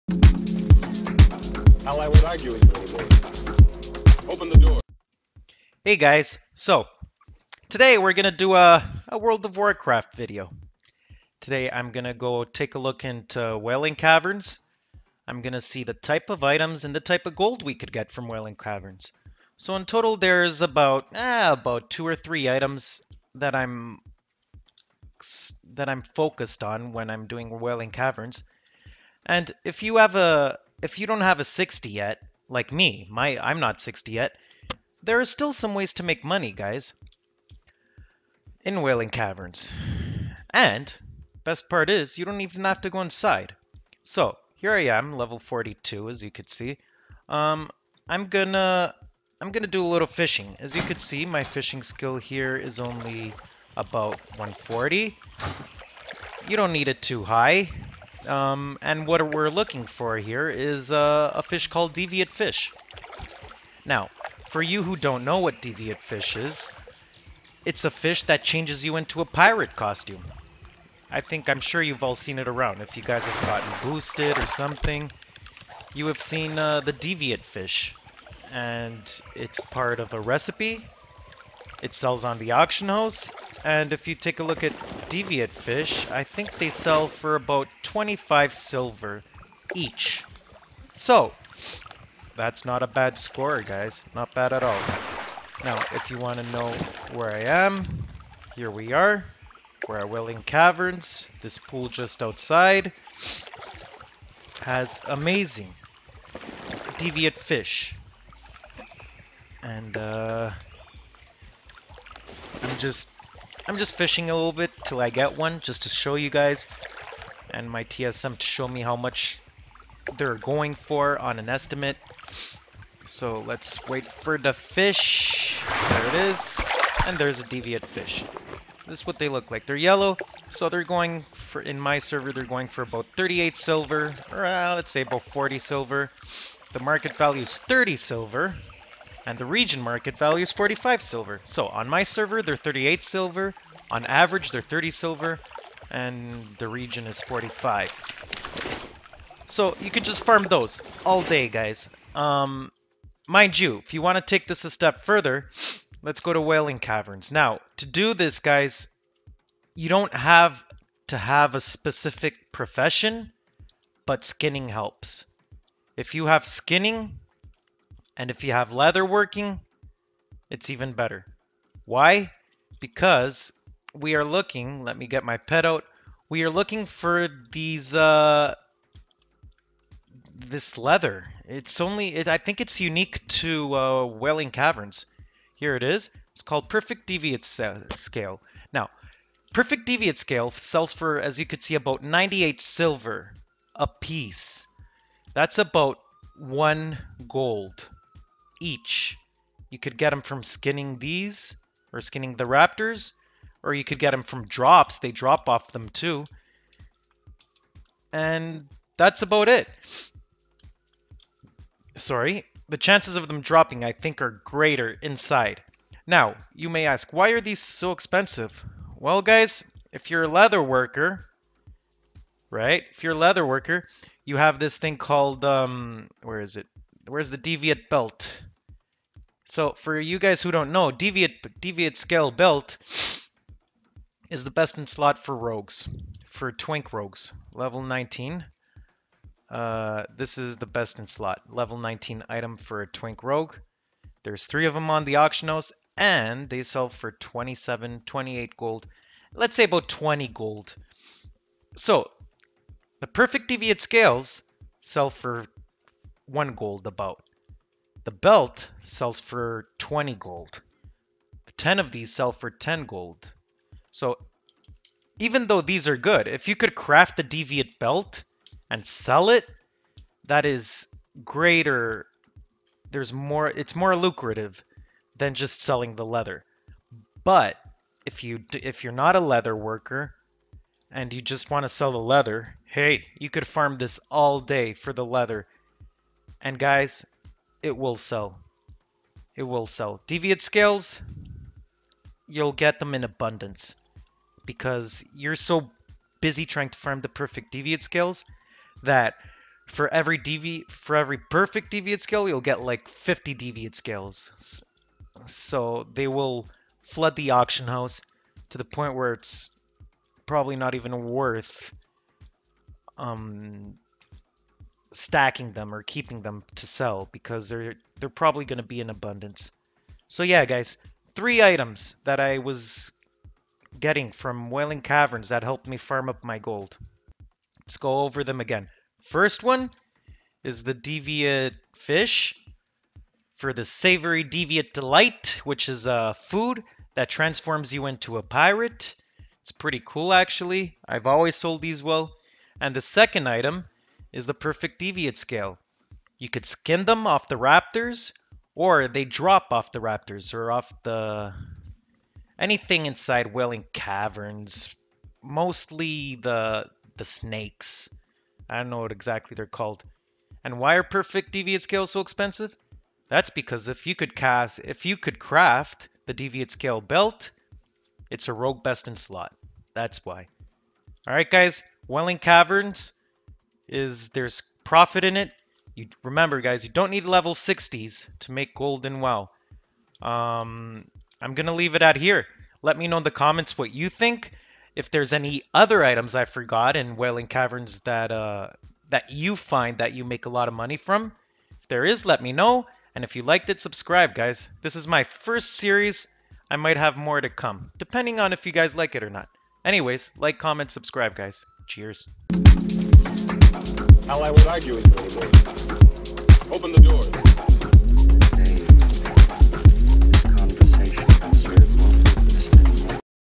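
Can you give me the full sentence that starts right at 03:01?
It's only, it, I think it's unique to uh, Wailing Caverns.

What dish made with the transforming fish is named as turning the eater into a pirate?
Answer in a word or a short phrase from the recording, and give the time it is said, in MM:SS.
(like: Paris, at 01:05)
Savory Deviant Delight, at 05:33.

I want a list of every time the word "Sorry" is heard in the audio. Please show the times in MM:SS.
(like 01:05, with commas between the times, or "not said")
03:31.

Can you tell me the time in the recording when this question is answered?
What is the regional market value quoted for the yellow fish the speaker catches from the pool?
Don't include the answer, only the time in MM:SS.
02:20.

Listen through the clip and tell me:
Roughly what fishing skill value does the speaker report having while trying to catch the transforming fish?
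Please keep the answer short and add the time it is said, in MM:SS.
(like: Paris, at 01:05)
140, at 00:53.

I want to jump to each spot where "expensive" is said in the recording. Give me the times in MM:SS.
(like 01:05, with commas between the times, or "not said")
03:37, 06:02.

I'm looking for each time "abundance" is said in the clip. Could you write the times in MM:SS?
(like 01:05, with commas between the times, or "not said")
04:53, 05:18.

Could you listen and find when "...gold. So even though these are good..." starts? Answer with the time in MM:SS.
04:22.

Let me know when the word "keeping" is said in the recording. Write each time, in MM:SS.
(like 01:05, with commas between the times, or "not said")
05:15.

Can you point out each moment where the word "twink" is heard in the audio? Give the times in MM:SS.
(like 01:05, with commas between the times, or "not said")
03:56, 04:02.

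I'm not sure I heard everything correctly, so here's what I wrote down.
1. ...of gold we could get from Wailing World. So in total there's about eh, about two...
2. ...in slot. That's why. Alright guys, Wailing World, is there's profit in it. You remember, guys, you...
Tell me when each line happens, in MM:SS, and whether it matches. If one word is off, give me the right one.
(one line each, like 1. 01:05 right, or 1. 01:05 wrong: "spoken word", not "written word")
1. 00:17 wrong: "Caverns", not "World"
2. 06:08 wrong: "Caverns", not "World".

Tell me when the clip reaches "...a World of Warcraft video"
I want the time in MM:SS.
00:09.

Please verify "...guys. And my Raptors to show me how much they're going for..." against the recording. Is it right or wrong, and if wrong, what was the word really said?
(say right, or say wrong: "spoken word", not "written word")
wrong: "TSM", not "Raptors".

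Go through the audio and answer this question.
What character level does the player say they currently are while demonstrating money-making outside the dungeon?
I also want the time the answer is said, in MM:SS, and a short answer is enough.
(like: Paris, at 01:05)
42, at 00:45.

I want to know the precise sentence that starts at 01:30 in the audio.
So, that's not a bad score, guys.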